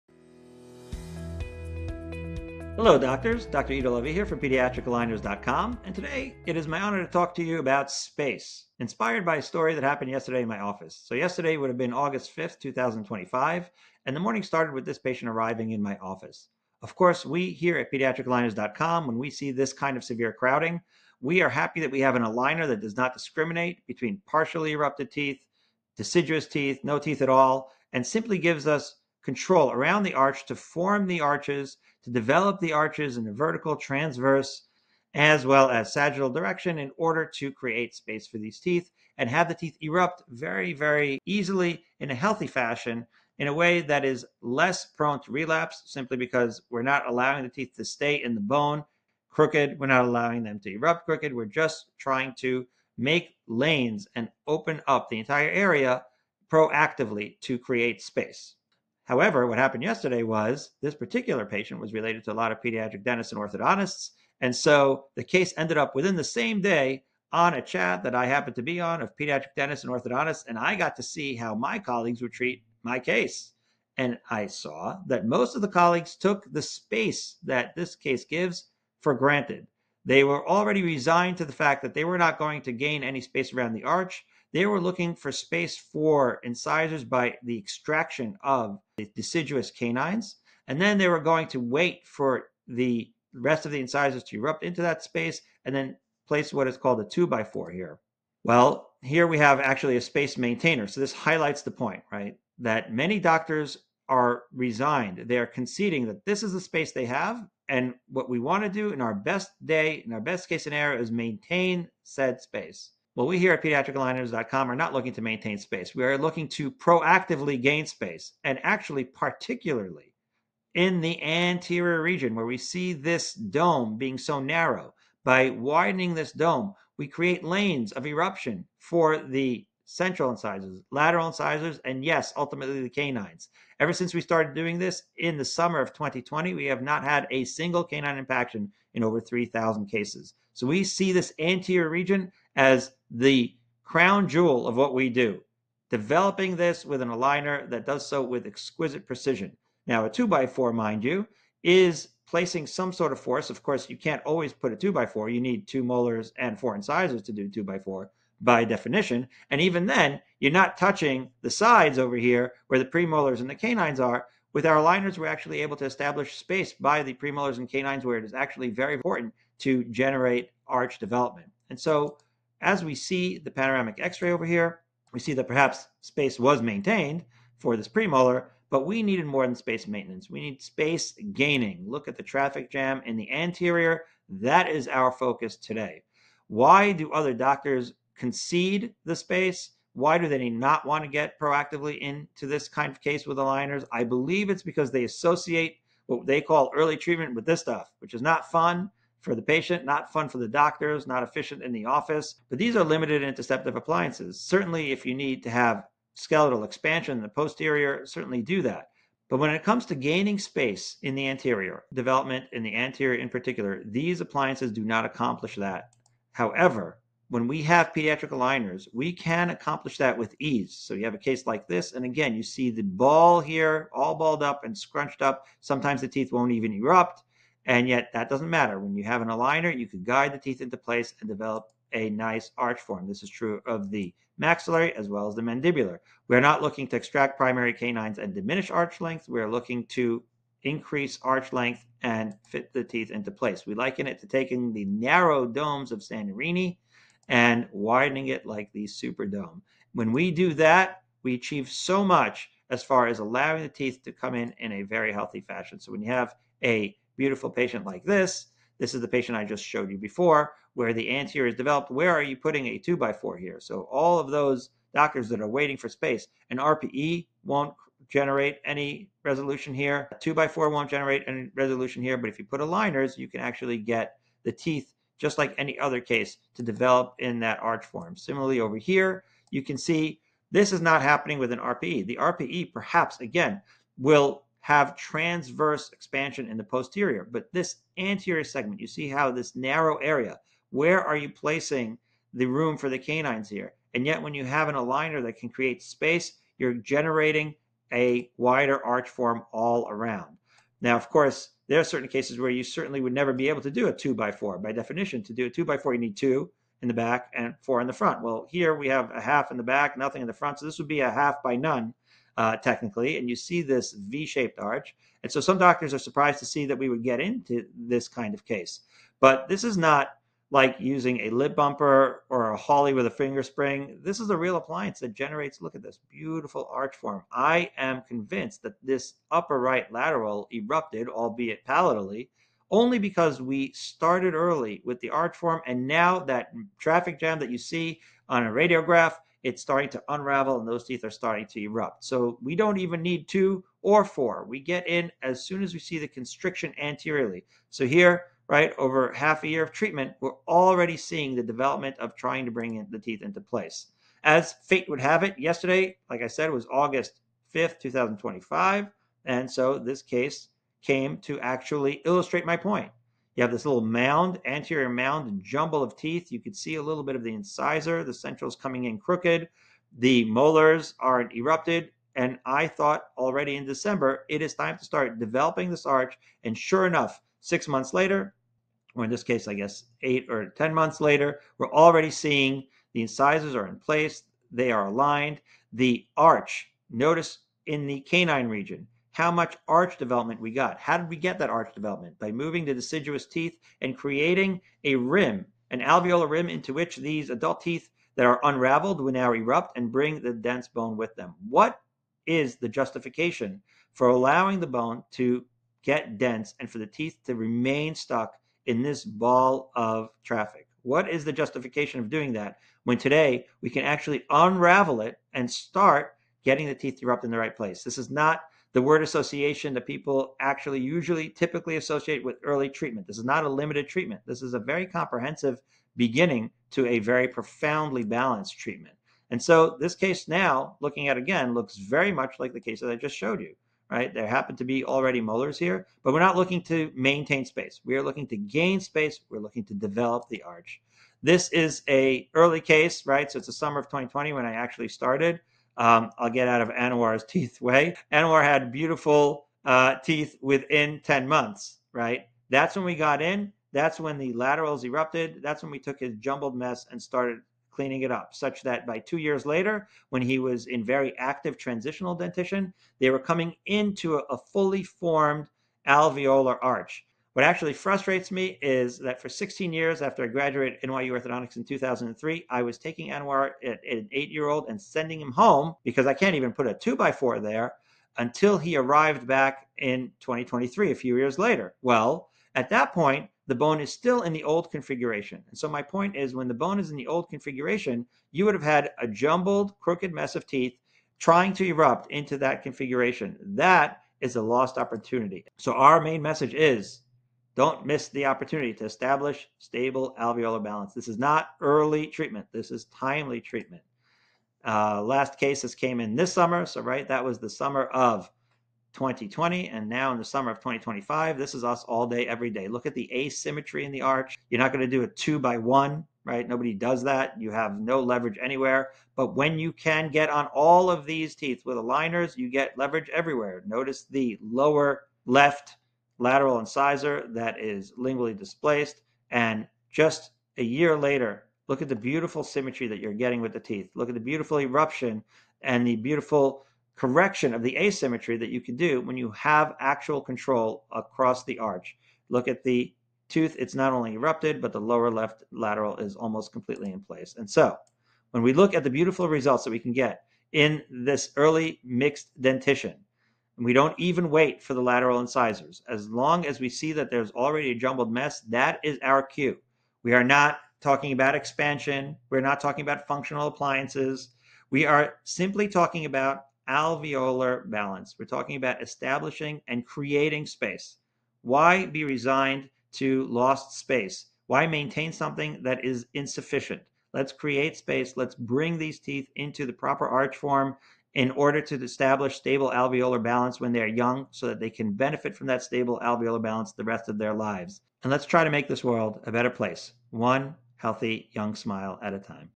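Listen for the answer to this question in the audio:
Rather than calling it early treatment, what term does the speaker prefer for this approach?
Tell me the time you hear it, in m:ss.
8:22.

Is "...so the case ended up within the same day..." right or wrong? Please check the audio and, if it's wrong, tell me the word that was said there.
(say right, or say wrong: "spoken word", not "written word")
right.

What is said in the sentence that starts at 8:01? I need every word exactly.
Well, at that point, the bone is still in the old configuration.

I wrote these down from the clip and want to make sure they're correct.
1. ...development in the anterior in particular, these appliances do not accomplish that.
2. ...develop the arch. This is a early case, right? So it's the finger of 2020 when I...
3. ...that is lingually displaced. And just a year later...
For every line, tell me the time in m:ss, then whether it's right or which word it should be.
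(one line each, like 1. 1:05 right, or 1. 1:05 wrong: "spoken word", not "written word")
1. 3:31 right
2. 7:19 wrong: "summer", not "finger"
3. 8:47 right.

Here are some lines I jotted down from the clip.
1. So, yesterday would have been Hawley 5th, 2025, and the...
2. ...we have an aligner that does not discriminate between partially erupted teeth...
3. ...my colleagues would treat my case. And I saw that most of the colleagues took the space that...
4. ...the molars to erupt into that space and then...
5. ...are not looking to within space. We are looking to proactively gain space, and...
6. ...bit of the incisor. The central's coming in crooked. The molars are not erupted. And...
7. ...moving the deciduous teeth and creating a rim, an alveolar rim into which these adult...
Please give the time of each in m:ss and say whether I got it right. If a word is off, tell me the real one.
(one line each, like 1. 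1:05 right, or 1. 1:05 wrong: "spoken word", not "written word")
1. 0:11 wrong: "August", not "Hawley"
2. 0:21 right
3. 1:11 right
4. 1:33 wrong: "incisors", not "molars"
5. 1:54 wrong: "maintain", not "within"
6. 6:07 right
7. 6:32 right.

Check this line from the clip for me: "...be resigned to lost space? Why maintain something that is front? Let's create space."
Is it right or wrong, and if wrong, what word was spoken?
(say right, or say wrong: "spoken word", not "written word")
wrong: "insufficient", not "front".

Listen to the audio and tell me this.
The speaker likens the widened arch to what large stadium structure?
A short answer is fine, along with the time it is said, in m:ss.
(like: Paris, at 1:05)
Superdome, at 4:08.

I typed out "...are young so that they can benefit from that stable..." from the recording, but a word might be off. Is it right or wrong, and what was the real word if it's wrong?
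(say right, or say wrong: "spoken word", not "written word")
right.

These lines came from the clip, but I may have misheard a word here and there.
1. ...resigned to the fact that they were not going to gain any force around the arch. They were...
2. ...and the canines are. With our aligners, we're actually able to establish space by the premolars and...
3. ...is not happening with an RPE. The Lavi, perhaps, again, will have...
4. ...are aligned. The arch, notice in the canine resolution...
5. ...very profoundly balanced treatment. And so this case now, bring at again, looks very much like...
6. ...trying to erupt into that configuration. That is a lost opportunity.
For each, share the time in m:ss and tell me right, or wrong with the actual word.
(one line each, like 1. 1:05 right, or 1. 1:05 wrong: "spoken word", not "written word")
1. 1:20 wrong: "space", not "force"
2. 2:43 right
3. 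4:40 wrong: "RPE", not "Lavi"
4. 6:24 wrong: "region", not "resolution"
5. 7:06 wrong: "looking", not "bring"
6. 8:11 right.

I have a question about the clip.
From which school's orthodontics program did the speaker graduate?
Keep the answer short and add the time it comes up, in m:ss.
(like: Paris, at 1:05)
NYU, at 7:50.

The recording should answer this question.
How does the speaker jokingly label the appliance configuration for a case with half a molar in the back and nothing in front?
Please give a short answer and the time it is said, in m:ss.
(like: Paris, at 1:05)
half by none, at 5:11.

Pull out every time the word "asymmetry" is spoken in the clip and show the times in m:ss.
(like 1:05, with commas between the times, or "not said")
8:33, 8:57.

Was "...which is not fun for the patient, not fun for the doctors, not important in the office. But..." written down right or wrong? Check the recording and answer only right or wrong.
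wrong.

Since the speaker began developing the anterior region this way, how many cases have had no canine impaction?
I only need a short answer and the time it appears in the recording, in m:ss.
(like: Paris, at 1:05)
over 3,000, at 2:19.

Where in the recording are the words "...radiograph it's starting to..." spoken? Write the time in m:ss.
5:38.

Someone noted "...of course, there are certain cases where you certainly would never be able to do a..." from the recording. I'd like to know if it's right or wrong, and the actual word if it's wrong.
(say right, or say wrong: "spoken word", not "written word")
right.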